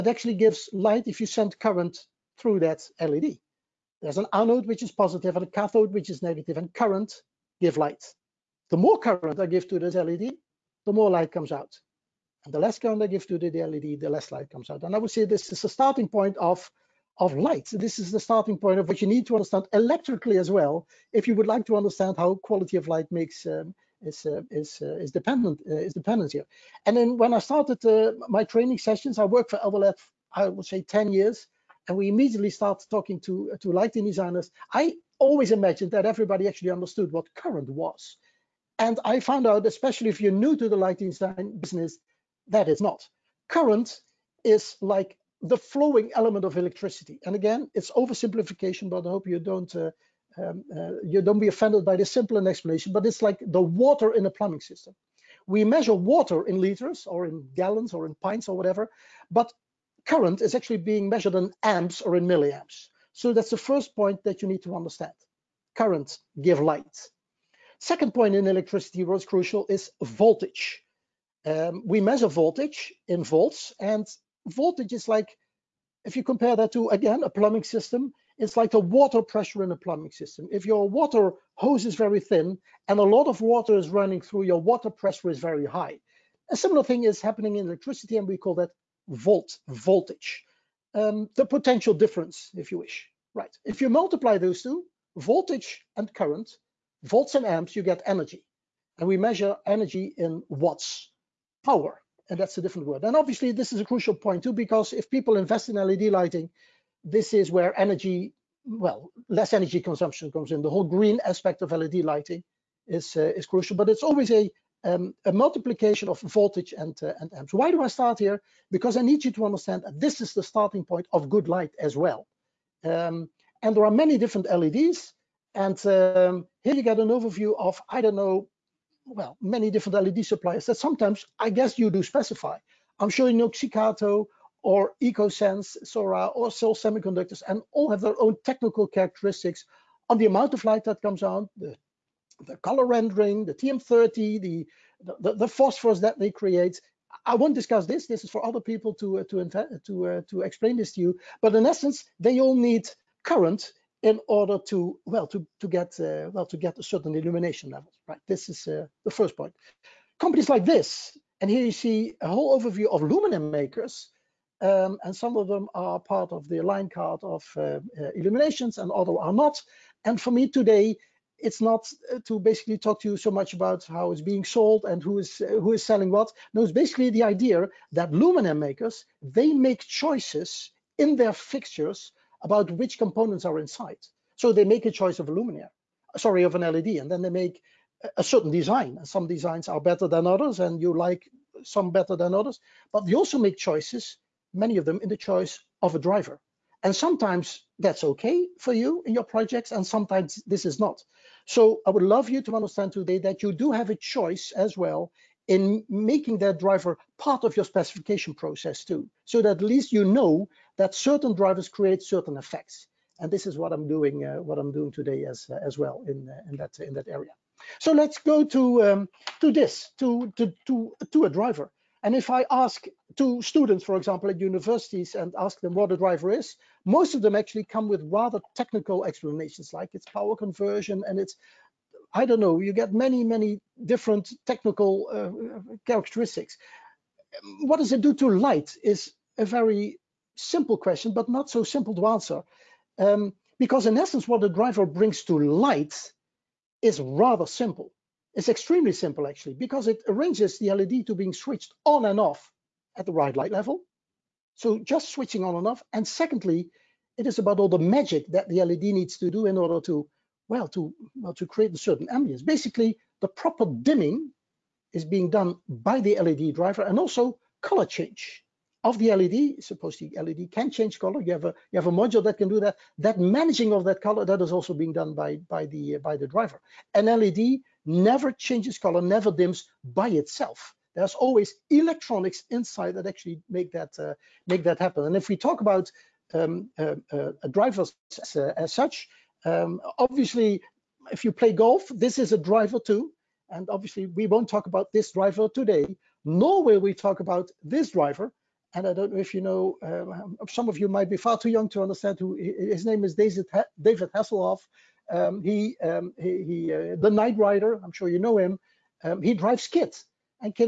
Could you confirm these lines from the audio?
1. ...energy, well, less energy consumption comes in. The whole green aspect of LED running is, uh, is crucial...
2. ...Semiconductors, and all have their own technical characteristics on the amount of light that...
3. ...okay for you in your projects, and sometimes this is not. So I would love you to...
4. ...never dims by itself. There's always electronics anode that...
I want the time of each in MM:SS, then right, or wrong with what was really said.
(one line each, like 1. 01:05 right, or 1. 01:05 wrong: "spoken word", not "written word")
1. 01:47 wrong: "lighting", not "running"
2. 02:16 right
3. 03:18 right
4. 04:39 wrong: "inside", not "anode".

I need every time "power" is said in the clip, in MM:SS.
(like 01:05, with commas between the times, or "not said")
01:41, 03:50.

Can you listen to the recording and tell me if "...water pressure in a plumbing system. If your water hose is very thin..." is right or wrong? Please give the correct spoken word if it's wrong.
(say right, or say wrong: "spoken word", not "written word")
right.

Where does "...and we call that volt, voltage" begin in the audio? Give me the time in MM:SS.
01:28.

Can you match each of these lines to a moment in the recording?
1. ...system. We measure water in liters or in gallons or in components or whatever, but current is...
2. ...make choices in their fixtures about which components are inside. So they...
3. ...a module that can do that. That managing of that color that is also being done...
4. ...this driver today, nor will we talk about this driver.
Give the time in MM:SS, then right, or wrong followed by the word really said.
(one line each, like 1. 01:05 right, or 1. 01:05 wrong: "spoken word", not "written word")
1. 00:54 wrong: "pints", not "components"
2. 02:59 right
3. 04:31 right
4. 04:54 right.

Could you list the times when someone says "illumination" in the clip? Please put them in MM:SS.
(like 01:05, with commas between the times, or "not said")
02:37, 02:48.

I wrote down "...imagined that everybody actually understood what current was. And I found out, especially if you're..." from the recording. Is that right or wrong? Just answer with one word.
right.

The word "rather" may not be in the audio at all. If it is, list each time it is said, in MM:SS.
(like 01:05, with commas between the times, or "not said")
03:48, 04:06.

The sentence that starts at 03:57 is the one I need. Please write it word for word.
What does it do to light is a very simple question, but not so simple to answer.